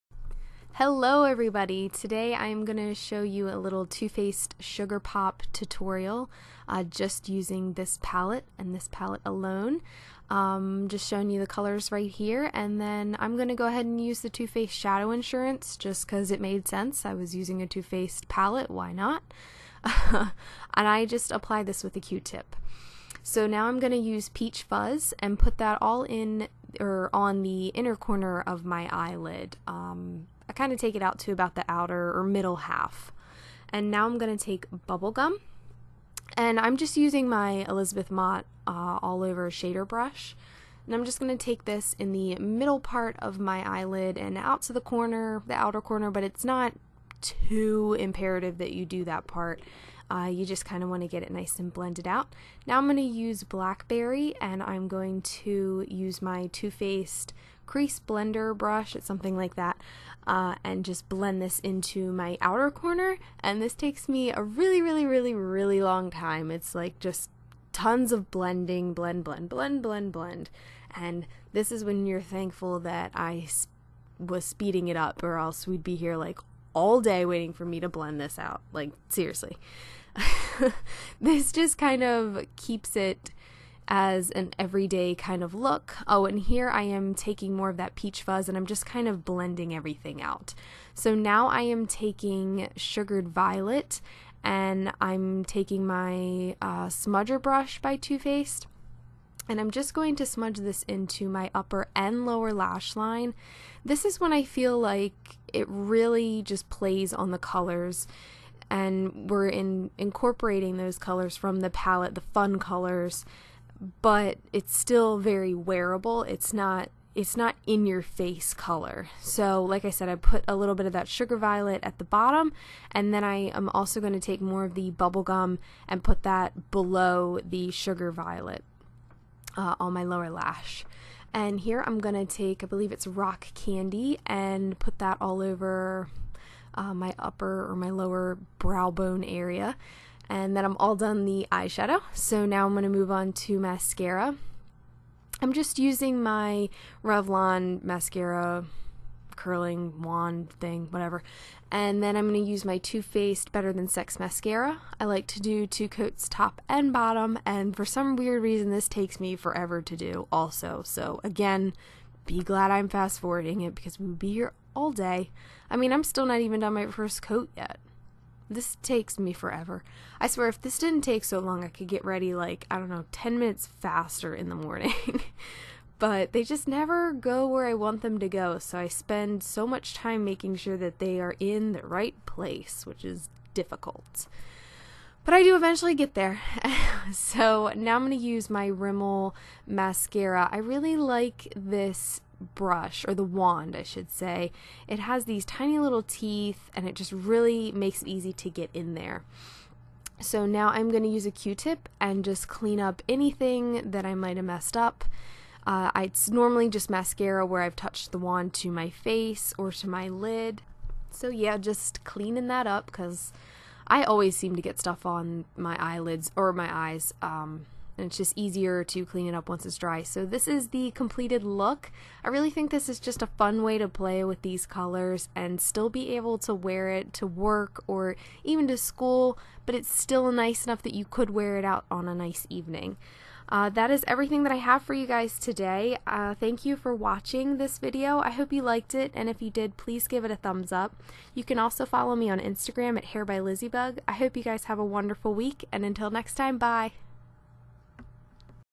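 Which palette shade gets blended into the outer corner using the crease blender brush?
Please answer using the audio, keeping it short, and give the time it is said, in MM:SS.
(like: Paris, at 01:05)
Blackberry, at 00:53.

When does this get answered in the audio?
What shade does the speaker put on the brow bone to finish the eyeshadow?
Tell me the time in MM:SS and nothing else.
02:13.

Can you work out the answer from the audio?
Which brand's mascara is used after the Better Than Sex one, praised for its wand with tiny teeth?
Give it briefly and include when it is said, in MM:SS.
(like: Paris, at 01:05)
Rimmel, at 03:08.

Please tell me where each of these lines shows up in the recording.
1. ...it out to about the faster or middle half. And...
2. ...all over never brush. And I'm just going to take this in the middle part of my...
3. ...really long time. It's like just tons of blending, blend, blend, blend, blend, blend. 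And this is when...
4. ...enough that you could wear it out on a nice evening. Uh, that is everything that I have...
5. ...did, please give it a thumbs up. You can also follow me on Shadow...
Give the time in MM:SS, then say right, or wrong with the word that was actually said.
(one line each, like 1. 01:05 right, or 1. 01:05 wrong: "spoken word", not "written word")
1. 00:30 wrong: "outer", not "faster"
2. 00:39 wrong: "shader", not "never"
3. 01:05 right
4. 03:50 right
5. 03:59 wrong: "Instagram", not "Shadow".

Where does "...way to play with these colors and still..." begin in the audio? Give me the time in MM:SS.
03:43.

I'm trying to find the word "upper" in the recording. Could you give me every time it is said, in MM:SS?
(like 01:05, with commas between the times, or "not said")
01:41, 02:17.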